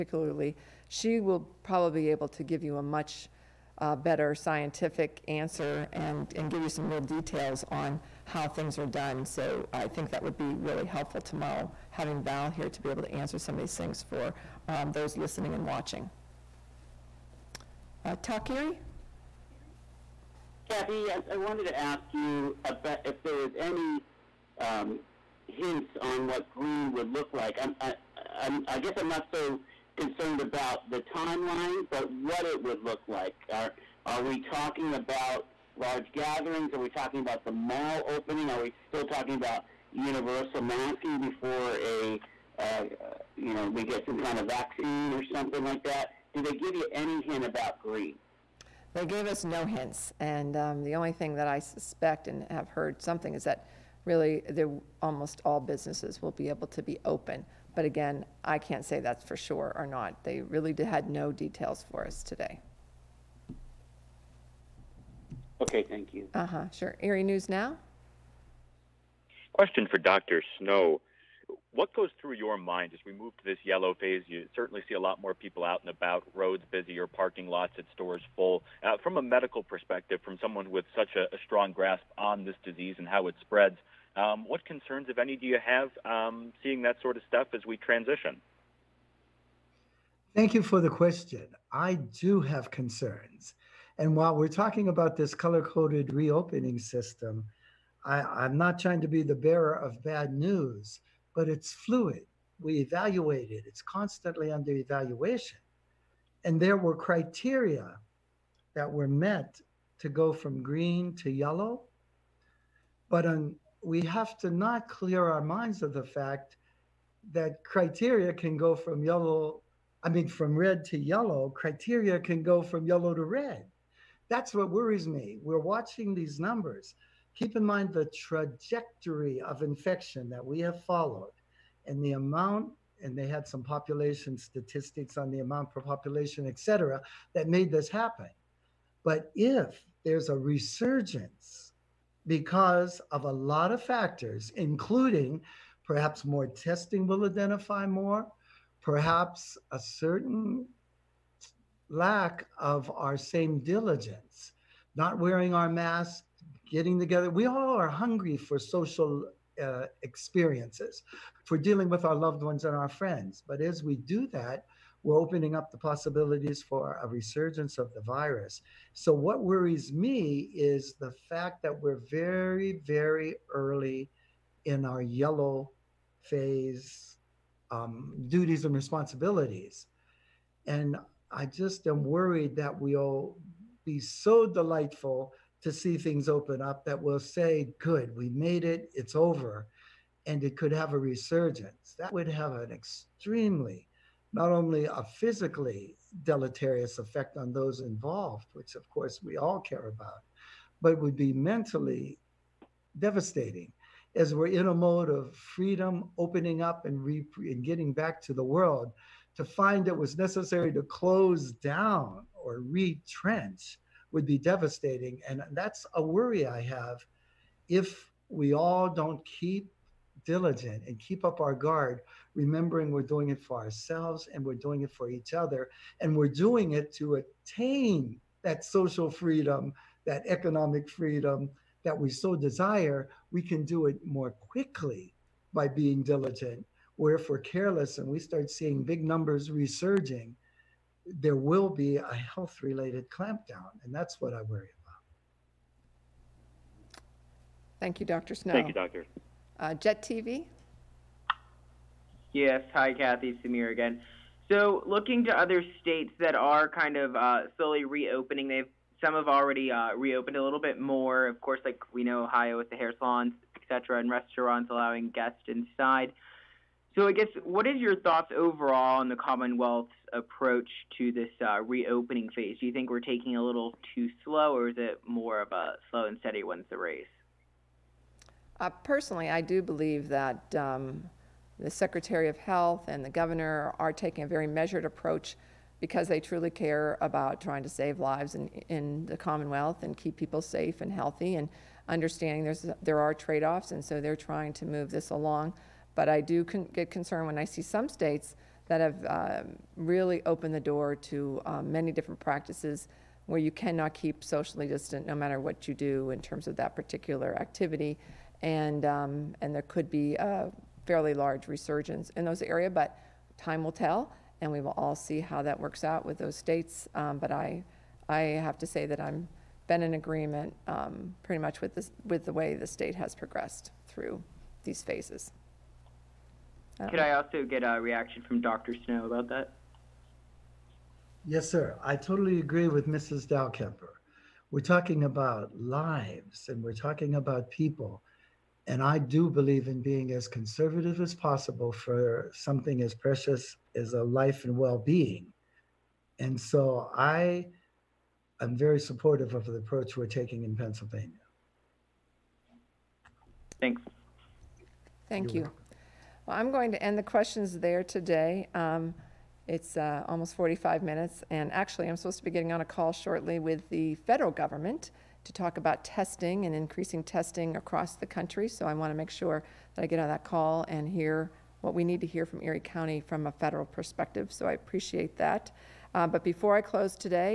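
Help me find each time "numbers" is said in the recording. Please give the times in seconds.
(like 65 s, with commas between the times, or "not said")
126 s, 239 s.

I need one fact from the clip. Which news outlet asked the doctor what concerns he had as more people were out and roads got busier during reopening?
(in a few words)
Erie News Now.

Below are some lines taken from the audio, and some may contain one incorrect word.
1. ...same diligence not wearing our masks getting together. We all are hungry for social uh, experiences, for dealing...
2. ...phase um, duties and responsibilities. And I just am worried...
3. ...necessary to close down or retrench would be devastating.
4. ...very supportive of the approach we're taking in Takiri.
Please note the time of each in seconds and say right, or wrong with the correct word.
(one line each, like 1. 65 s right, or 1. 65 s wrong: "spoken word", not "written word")
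1. 153 s right
2. 176 s right
3. 210 s right
4. 348 s wrong: "Pennsylvania", not "Takiri".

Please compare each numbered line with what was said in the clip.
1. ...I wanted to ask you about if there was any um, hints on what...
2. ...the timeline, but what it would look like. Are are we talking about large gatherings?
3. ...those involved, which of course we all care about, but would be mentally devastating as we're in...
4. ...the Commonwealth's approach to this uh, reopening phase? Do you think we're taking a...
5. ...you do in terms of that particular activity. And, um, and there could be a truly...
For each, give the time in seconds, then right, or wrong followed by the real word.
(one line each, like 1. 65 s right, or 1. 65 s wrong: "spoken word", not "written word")
1. 21 s right
2. 30 s right
3. 197 s right
4. 269 s right
5. 305 s wrong: "fairly", not "truly".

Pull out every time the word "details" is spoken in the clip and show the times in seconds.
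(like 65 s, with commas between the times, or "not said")
6 s, 61 s.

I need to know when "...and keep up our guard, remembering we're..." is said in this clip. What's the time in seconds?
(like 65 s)
220 s.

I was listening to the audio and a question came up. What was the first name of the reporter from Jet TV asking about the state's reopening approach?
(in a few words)
Samir.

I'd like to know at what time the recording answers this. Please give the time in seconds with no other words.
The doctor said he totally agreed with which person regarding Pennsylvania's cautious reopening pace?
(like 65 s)
332 s.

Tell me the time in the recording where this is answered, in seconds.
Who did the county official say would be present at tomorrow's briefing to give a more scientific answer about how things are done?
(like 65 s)
12 s.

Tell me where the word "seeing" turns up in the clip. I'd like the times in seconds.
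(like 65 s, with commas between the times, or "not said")
86 s, 238 s.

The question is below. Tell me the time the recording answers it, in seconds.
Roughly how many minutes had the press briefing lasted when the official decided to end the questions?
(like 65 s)
360 s.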